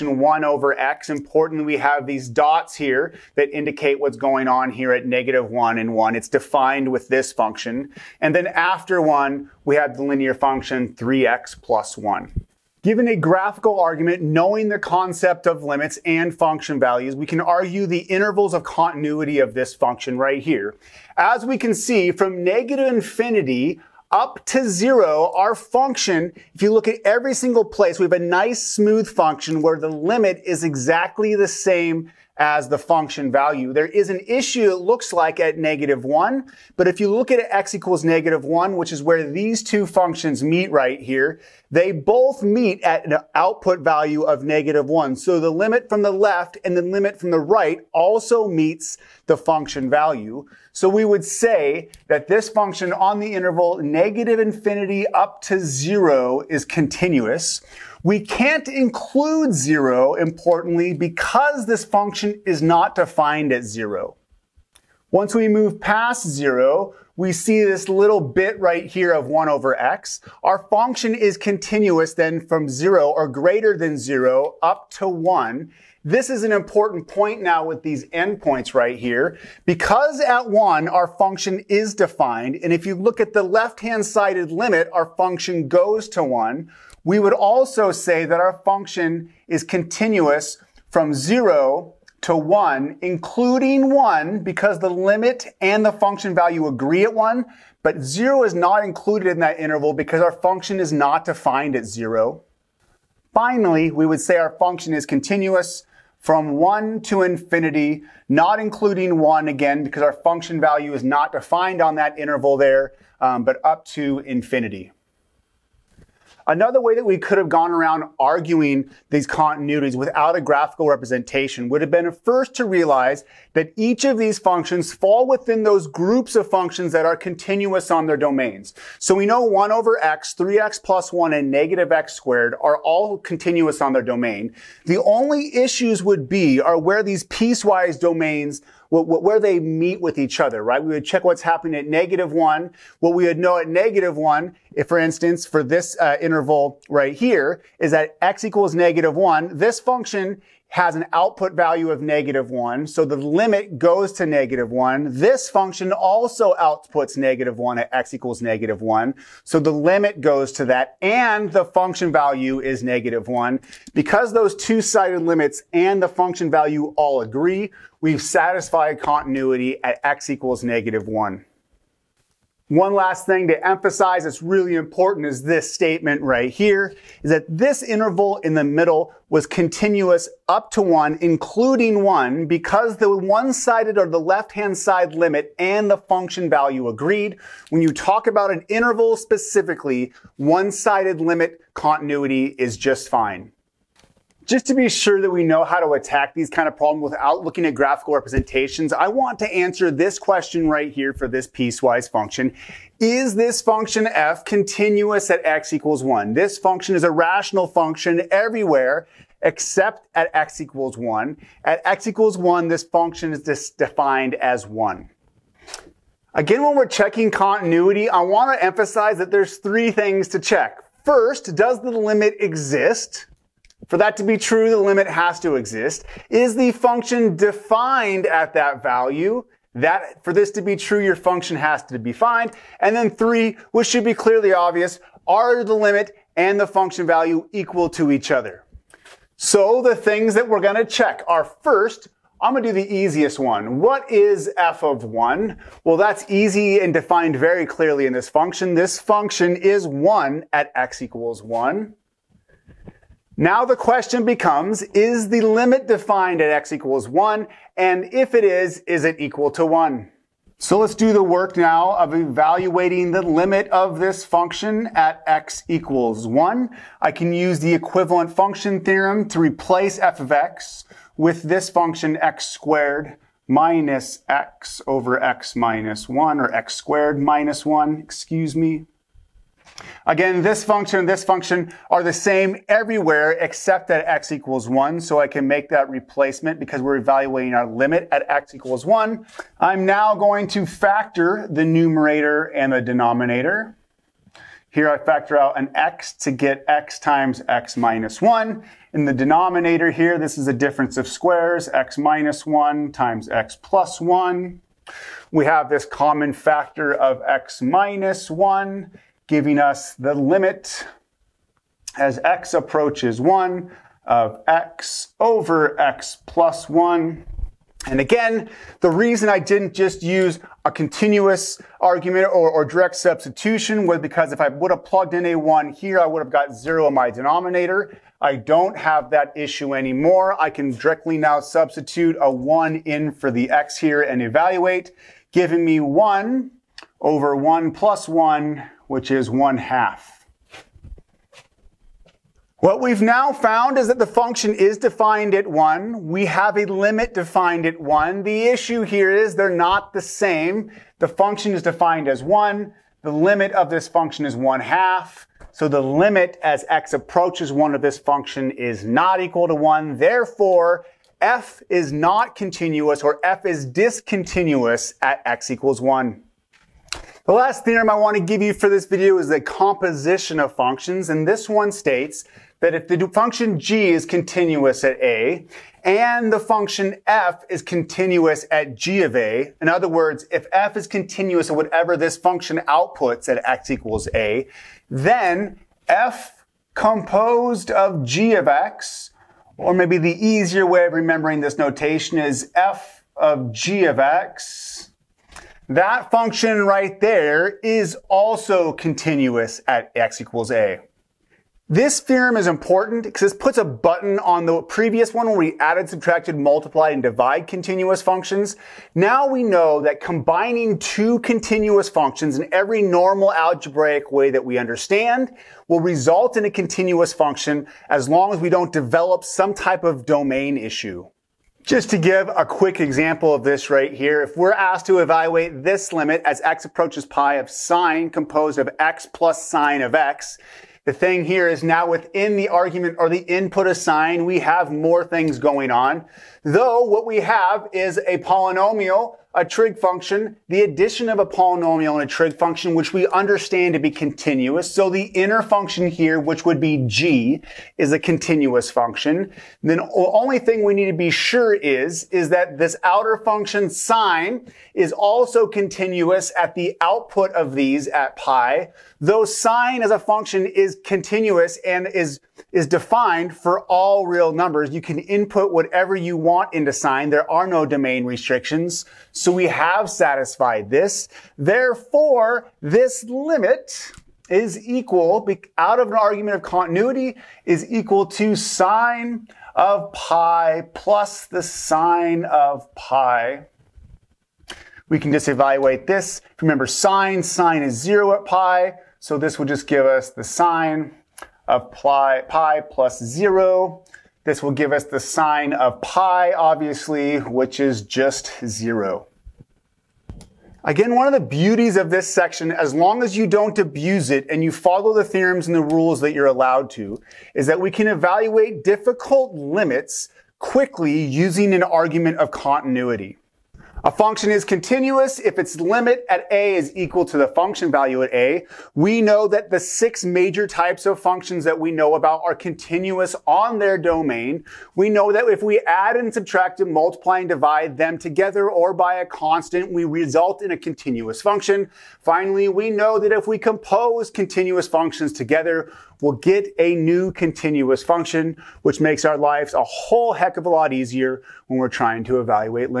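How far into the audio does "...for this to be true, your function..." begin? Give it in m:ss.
3:50.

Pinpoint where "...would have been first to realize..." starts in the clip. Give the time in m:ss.
2:01.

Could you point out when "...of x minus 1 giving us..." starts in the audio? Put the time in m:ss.
5:06.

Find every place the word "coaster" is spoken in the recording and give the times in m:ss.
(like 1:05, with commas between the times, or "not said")
not said.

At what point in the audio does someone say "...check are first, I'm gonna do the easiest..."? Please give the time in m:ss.
4:00.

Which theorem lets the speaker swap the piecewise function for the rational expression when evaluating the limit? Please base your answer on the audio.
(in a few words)
equivalent function theorem.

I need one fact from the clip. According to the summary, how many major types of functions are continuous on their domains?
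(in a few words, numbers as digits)
6.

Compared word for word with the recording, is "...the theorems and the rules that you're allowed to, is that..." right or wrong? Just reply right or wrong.
right.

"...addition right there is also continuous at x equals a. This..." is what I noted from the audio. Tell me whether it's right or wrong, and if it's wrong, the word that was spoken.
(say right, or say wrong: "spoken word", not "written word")
wrong: "function", not "addition".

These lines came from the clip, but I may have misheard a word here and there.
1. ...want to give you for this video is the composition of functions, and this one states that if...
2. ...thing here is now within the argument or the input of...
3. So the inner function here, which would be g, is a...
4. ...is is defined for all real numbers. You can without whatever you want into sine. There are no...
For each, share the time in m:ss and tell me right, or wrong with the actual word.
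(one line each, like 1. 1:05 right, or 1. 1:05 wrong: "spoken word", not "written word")
1. 6:07 right
2. 7:10 right
3. 7:24 right
4. 7:41 wrong: "input", not "without".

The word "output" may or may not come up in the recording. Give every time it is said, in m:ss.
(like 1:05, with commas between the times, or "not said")
0:43, 2:31, 2:36, 6:22, 7:36.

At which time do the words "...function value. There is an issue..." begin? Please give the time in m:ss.
0:32.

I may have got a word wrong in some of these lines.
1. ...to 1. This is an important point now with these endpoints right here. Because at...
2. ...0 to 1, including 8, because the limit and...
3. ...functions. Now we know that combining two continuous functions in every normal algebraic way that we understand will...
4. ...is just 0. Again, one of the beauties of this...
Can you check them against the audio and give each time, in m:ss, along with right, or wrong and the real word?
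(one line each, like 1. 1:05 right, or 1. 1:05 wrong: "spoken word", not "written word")
1. 1:14 right
2. 1:31 wrong: "1", not "8"
3. 6:48 right
4. 8:17 right.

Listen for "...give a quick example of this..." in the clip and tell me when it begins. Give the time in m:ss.
7:01.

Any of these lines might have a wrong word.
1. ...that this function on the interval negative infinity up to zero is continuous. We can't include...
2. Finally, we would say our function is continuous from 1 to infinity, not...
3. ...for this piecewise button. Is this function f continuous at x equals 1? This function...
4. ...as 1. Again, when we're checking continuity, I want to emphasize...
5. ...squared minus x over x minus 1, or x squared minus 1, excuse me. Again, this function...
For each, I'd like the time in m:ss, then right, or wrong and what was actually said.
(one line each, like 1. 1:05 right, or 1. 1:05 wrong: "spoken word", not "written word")
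1. 0:52 right
2. 1:43 right
3. 3:21 wrong: "function", not "button"
4. 3:34 right
5. 4:32 right.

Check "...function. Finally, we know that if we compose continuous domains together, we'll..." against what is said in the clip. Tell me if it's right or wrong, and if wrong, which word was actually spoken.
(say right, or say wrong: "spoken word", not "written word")
wrong: "functions", not "domains".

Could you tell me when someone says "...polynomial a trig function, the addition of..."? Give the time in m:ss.
7:18.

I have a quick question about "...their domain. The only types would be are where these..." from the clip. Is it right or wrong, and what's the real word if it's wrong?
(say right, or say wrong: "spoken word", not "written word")
wrong: "issues", not "types".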